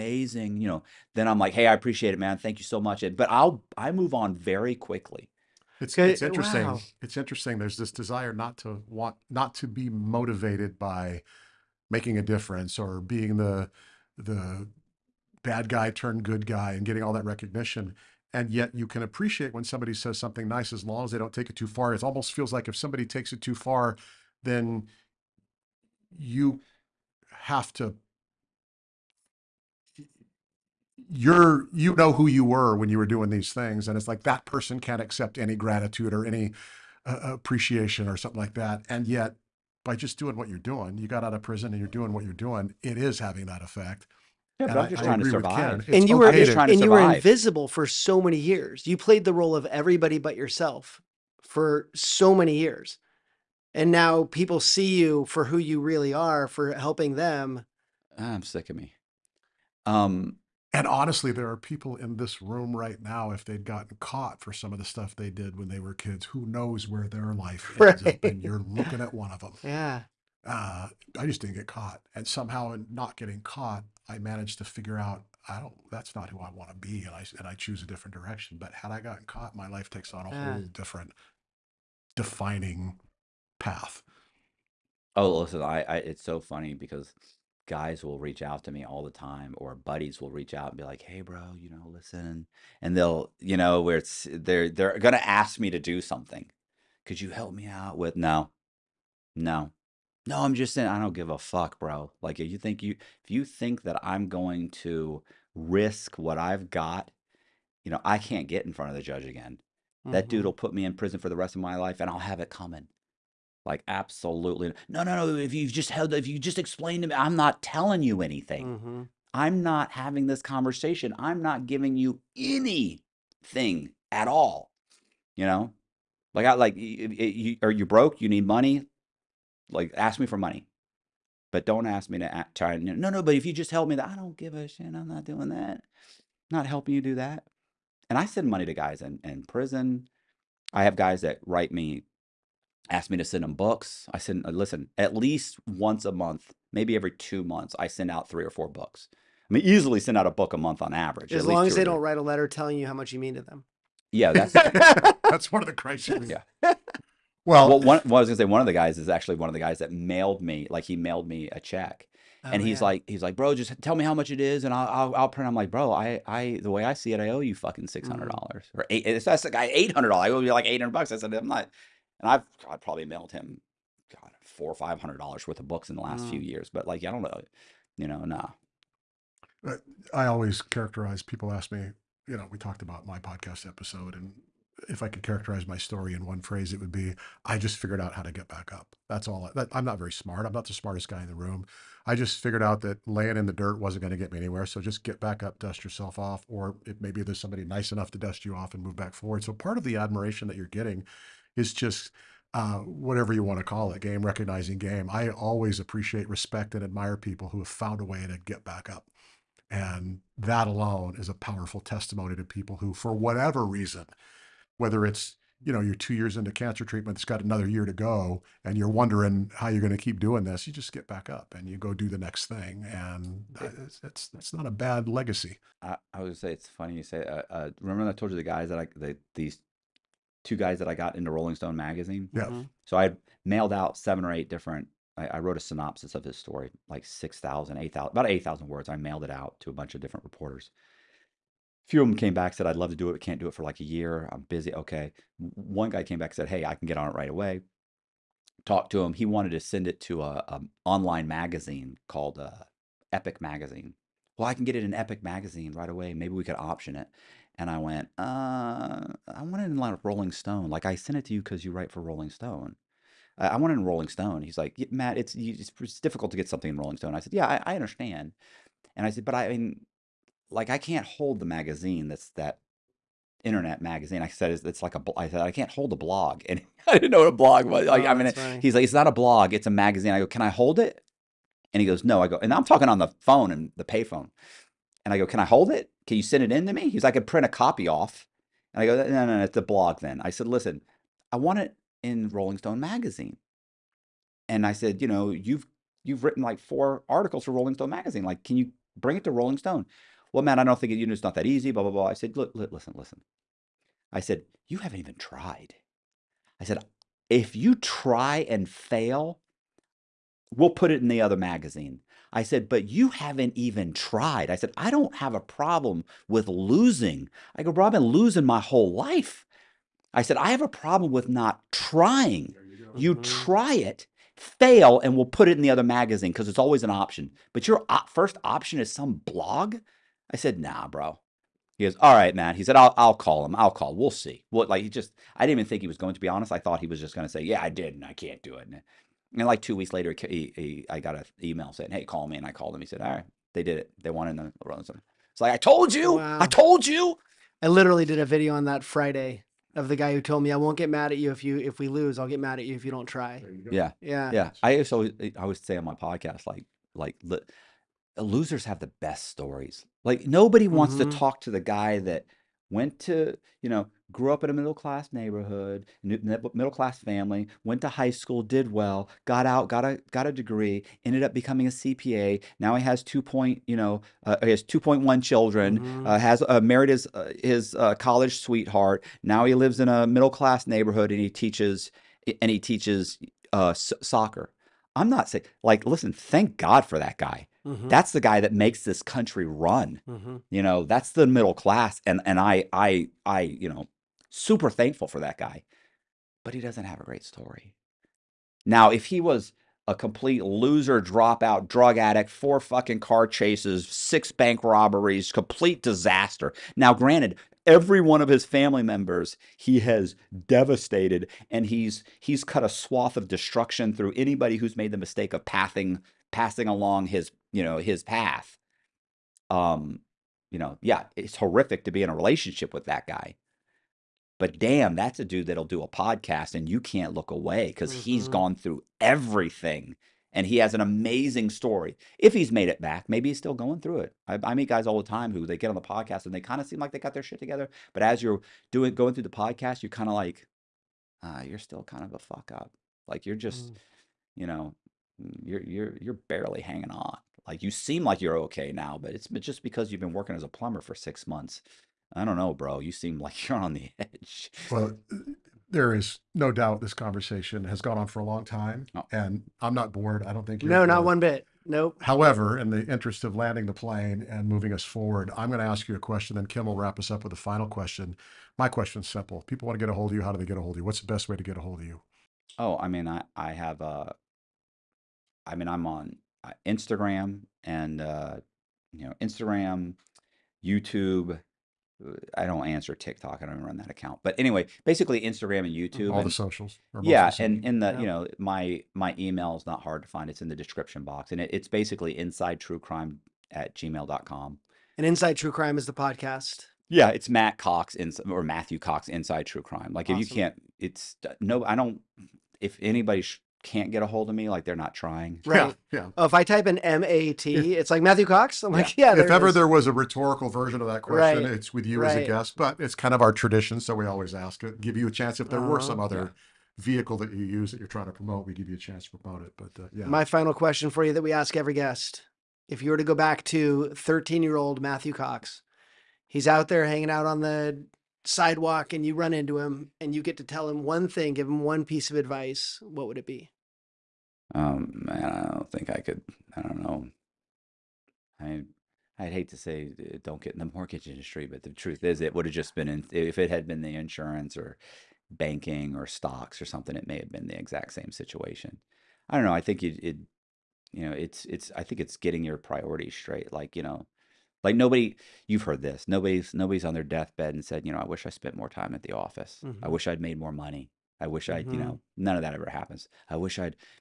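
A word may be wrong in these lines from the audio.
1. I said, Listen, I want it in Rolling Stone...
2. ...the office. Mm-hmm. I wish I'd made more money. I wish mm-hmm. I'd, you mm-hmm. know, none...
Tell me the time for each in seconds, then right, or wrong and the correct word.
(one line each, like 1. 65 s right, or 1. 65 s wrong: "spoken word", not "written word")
1. 290 s right
2. 559 s right.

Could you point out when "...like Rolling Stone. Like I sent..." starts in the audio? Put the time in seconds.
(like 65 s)
259 s.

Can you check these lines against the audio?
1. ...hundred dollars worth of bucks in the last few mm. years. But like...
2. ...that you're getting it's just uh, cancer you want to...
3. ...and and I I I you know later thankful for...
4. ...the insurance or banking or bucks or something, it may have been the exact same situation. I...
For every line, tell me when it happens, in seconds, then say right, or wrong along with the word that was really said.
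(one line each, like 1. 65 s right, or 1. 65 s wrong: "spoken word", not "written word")
1. 174 s wrong: "books", not "bucks"
2. 200 s wrong: "whatever", not "cancer"
3. 392 s wrong: "super", not "later"
4. 543 s wrong: "stocks", not "bucks".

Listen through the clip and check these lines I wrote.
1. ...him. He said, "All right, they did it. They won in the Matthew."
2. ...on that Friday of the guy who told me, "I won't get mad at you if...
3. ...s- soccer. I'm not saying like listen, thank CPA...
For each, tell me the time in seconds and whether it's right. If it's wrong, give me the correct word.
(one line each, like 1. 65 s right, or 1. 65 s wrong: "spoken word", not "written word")
1. 342 s wrong: "Robinson", not "Matthew"
2. 348 s right
3. 383 s wrong: "God", not "CPA".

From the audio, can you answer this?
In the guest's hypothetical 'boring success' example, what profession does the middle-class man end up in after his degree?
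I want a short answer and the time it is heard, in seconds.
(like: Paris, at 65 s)
CPA, at 371 s.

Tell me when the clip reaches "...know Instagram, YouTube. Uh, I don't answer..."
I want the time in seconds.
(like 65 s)
479 s.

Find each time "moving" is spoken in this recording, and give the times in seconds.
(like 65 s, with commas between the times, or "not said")
464 s.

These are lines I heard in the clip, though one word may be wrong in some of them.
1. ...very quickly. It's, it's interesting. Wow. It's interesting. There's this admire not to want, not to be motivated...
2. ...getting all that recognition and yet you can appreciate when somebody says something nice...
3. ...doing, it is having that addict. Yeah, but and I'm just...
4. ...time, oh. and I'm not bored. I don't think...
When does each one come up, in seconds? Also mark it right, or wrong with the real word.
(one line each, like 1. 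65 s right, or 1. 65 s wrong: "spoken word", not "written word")
1. 4 s wrong: "desire", not "admire"
2. 16 s right
3. 42 s wrong: "effect", not "addict"
4. 458 s right.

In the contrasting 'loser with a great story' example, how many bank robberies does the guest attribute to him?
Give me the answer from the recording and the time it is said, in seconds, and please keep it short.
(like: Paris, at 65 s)
6, at 403 s.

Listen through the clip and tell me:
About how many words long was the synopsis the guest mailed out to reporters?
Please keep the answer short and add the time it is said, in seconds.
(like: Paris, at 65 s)
8,000, at 238 s.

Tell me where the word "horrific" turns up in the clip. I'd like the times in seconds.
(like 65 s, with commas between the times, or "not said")
421 s.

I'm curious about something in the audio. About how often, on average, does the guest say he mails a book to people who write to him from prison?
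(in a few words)
A book a month.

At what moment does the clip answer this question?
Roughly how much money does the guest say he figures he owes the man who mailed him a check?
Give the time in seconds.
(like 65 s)
169 s.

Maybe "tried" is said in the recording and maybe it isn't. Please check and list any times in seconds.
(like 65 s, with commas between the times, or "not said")
305 s, 313 s.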